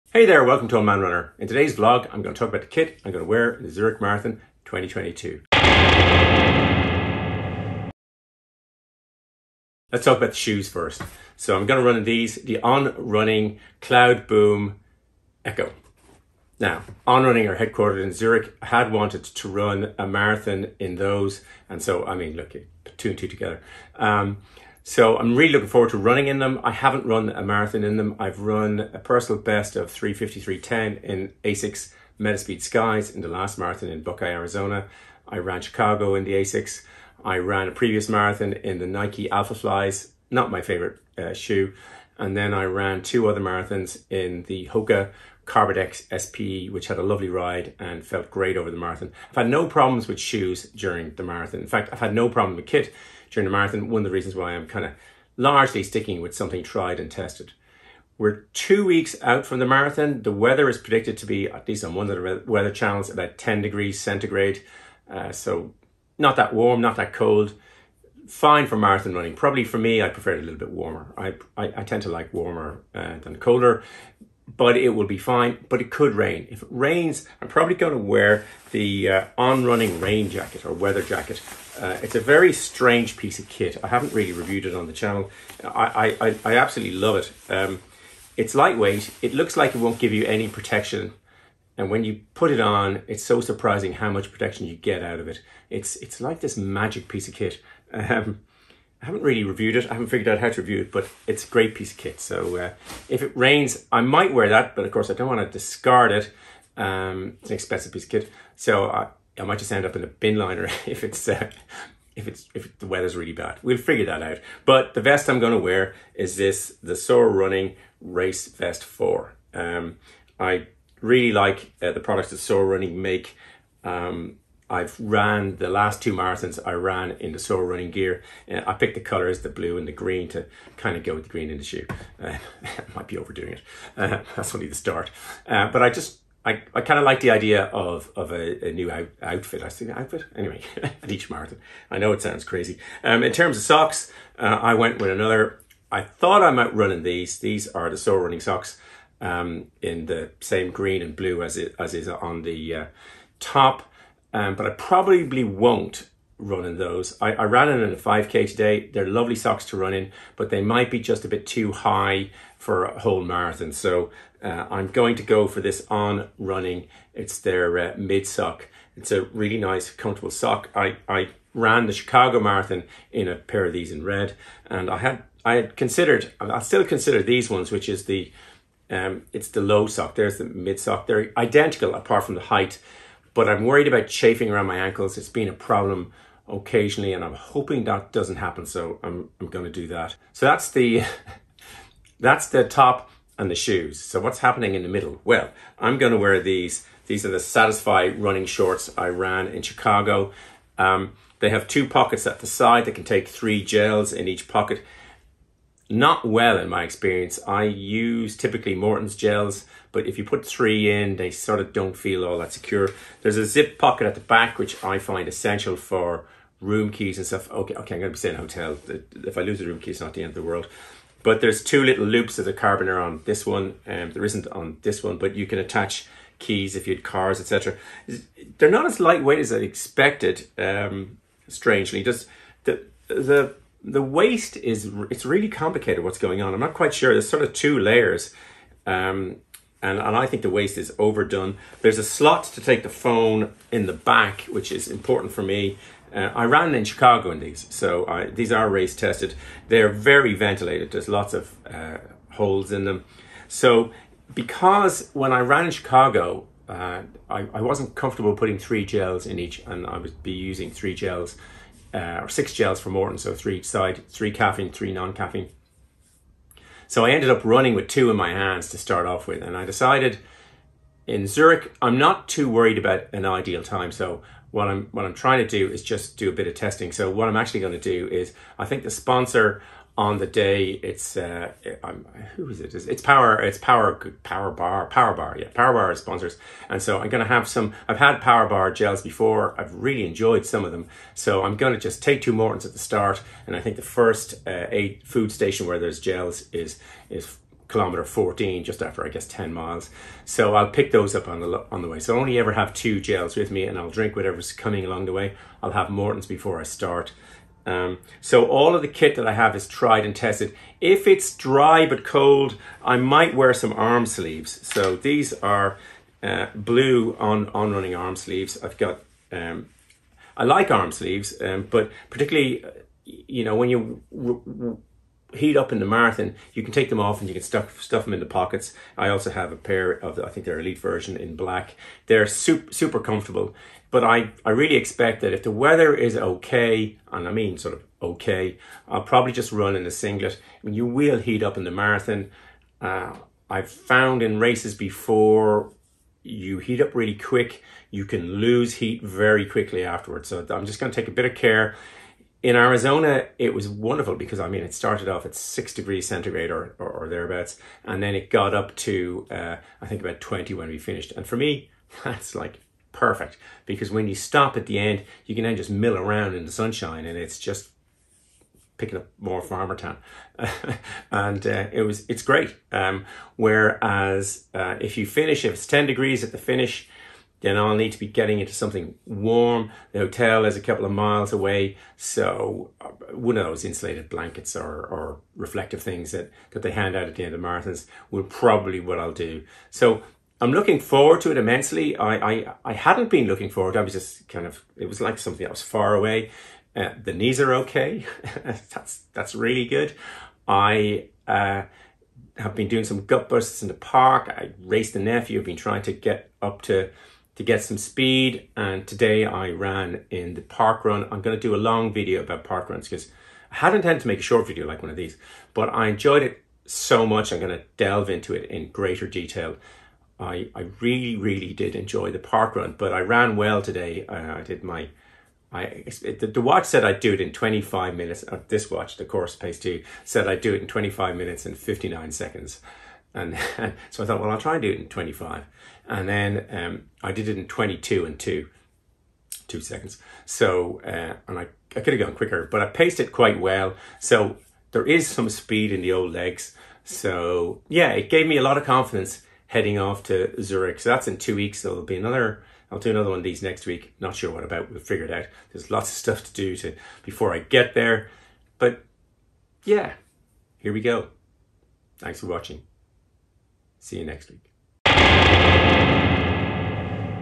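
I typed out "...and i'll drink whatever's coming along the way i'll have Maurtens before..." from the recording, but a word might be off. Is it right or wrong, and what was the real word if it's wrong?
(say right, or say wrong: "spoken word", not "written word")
right.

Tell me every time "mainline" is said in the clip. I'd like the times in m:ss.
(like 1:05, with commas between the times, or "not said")
not said.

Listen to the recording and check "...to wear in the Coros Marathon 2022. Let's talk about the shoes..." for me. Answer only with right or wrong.
wrong.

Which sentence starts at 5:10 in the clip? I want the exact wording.
If it's dry but cold, I might wear some arm sleeves.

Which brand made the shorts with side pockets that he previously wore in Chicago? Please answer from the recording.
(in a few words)
Satisfy.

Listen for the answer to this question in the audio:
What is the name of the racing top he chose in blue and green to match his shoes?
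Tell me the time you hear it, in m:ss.
1:58.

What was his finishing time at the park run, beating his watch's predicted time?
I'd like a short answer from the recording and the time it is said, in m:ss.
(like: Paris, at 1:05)
22:02, at 7:17.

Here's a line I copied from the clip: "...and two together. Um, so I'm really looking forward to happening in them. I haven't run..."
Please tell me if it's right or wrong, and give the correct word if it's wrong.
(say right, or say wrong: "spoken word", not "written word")
wrong: "running", not "happening".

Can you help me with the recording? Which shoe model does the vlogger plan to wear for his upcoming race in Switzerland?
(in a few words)
Cloudboom Echo.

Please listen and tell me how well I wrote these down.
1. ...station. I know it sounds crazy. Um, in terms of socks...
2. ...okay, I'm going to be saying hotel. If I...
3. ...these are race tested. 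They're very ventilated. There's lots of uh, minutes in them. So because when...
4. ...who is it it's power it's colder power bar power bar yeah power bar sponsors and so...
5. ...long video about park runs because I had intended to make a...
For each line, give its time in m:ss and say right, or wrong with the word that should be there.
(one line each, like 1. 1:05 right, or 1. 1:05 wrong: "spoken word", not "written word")
1. 2:21 wrong: "marathon", not "station"
2. 3:37 right
3. 4:08 wrong: "holes", not "minutes"
4. 4:42 wrong: "power", not "colder"
5. 6:51 right.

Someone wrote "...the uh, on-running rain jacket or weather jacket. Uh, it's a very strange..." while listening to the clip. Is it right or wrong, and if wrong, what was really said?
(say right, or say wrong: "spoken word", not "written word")
right.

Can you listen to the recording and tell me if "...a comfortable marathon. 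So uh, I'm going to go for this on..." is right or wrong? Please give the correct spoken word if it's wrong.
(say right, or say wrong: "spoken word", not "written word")
wrong: "whole", not "comfortable".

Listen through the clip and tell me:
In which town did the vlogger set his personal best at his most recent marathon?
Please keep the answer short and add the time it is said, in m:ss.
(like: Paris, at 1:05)
Buckeye, Arizona, at 0:34.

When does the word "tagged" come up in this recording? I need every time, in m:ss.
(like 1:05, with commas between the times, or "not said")
not said.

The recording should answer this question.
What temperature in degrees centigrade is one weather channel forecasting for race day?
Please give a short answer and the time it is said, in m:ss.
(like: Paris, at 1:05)
10, at 1:03.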